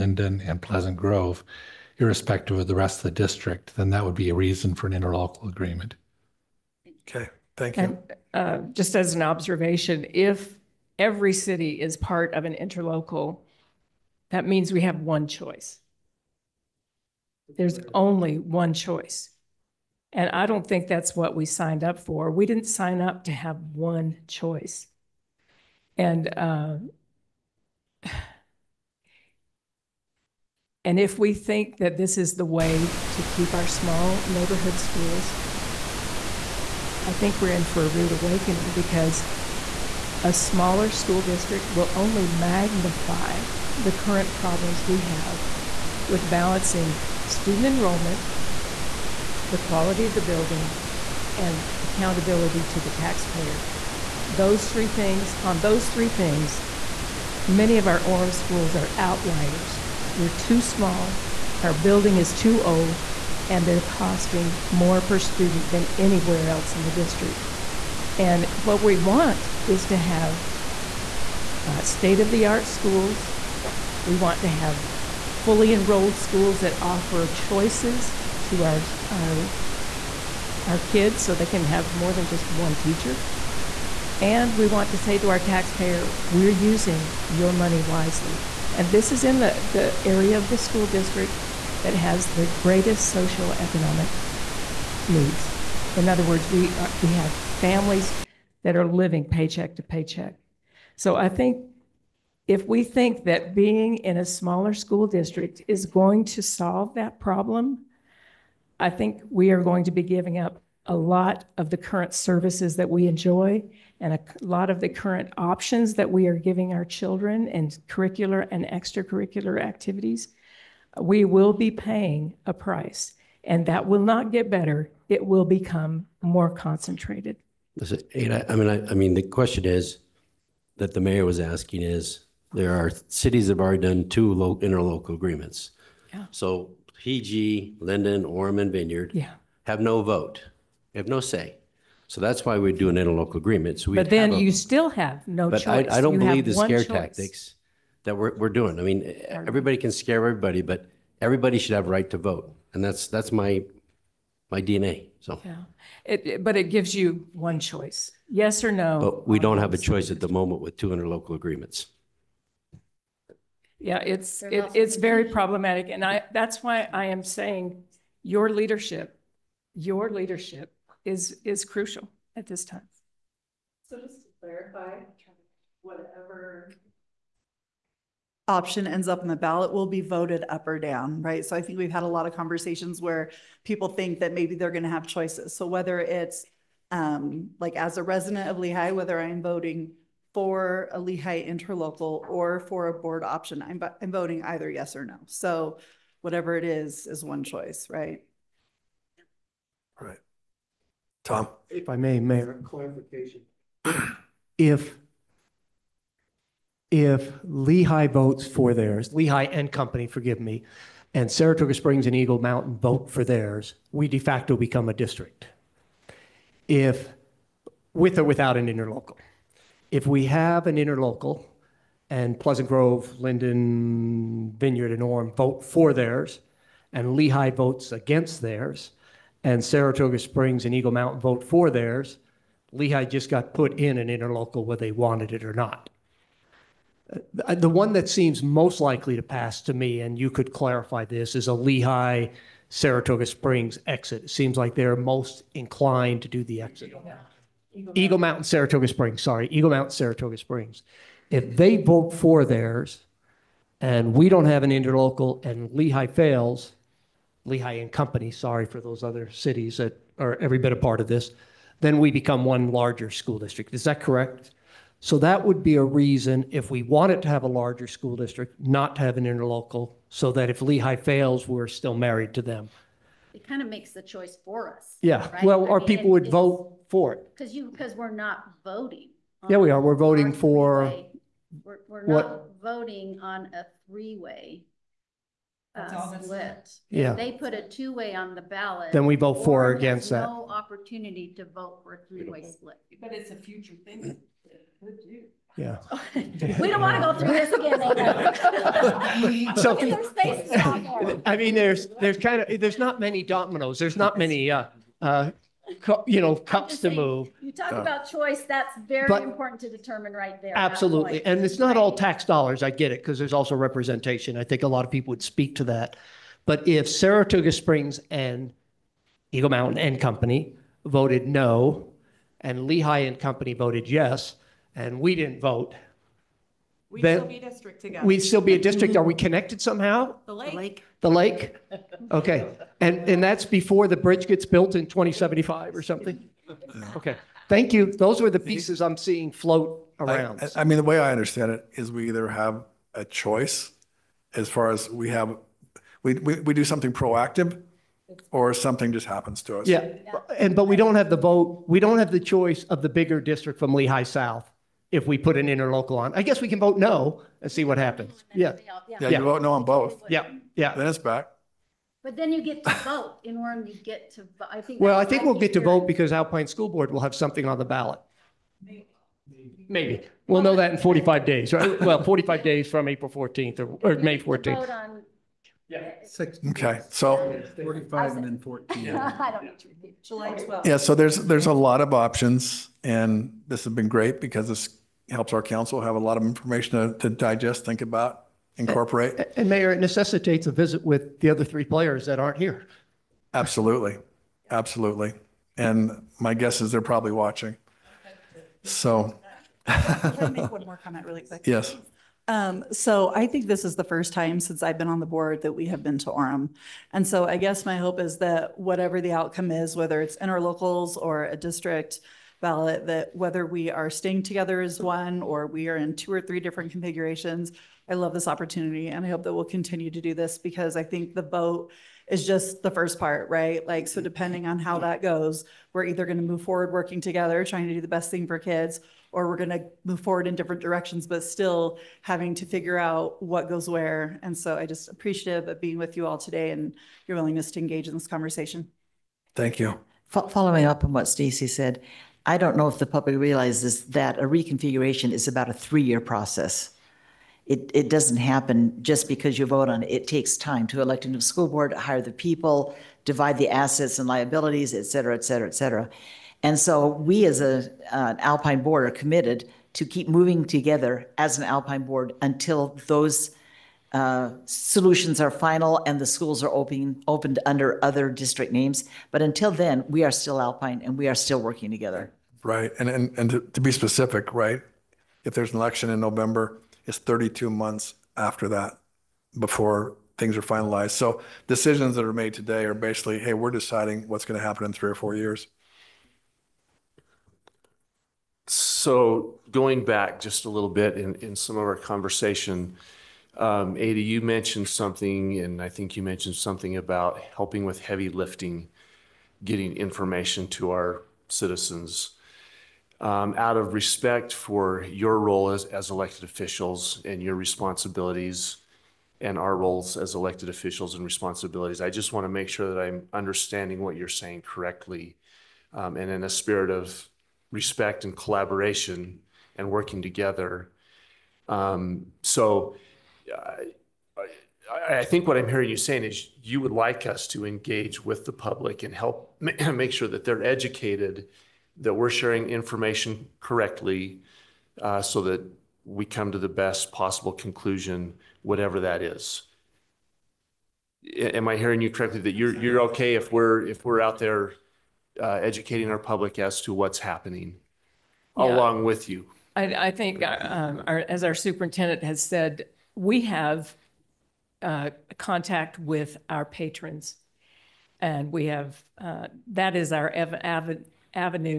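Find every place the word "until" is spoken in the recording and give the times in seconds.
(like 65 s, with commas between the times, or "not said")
462 s, 469 s.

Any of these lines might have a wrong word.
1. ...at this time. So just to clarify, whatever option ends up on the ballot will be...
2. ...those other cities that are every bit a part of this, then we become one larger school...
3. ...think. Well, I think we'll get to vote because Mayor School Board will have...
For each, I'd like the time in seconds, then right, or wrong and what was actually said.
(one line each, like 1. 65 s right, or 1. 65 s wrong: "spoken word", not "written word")
1. 172 s right
2. 258 s right
3. 364 s wrong: "Alpine", not "Mayor".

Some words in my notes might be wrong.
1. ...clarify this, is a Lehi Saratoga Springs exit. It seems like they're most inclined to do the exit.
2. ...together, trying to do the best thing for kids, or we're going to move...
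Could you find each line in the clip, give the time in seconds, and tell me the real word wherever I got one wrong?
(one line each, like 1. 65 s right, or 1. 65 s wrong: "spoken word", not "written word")
1. 240 s right
2. 427 s right.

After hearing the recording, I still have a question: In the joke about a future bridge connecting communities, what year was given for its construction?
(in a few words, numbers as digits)
2075.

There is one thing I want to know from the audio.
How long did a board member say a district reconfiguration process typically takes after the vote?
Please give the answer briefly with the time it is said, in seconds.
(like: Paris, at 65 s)
3 years, at 445 s.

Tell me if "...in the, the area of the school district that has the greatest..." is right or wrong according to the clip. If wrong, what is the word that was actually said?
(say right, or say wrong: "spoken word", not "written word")
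right.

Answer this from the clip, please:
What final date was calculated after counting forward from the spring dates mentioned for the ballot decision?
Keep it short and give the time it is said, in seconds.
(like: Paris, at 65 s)
July 12th, at 380 s.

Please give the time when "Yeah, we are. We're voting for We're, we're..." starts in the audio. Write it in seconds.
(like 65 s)
279 s.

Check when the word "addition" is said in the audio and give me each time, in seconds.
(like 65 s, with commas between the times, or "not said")
not said.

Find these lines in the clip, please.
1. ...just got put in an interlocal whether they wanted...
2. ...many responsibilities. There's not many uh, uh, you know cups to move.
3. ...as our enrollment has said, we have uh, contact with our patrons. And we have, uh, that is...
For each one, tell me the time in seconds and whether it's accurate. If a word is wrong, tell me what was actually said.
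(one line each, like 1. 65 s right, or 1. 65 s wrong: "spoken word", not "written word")
1. 233 s right
2. 303 s wrong: "dominoes", not "responsibilities"
3. 551 s wrong: "superintendent", not "enrollment".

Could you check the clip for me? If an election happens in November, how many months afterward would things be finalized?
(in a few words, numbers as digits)
32.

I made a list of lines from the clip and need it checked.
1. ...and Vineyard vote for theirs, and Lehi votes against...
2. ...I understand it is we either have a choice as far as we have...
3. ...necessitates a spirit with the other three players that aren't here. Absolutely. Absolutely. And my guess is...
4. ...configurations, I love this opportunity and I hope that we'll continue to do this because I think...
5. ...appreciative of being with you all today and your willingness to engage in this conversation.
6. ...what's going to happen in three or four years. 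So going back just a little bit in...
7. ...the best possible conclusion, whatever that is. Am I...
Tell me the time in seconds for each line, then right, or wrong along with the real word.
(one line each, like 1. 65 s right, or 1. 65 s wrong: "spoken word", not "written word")
1. 224 s wrong: "Orem", not "Vineyard"
2. 340 s right
3. 389 s wrong: "visit", not "spirit"
4. 416 s right
5. 434 s right
6. 484 s right
7. 536 s right.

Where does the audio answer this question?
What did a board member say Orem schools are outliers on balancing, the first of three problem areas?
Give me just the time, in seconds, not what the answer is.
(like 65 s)
47 s.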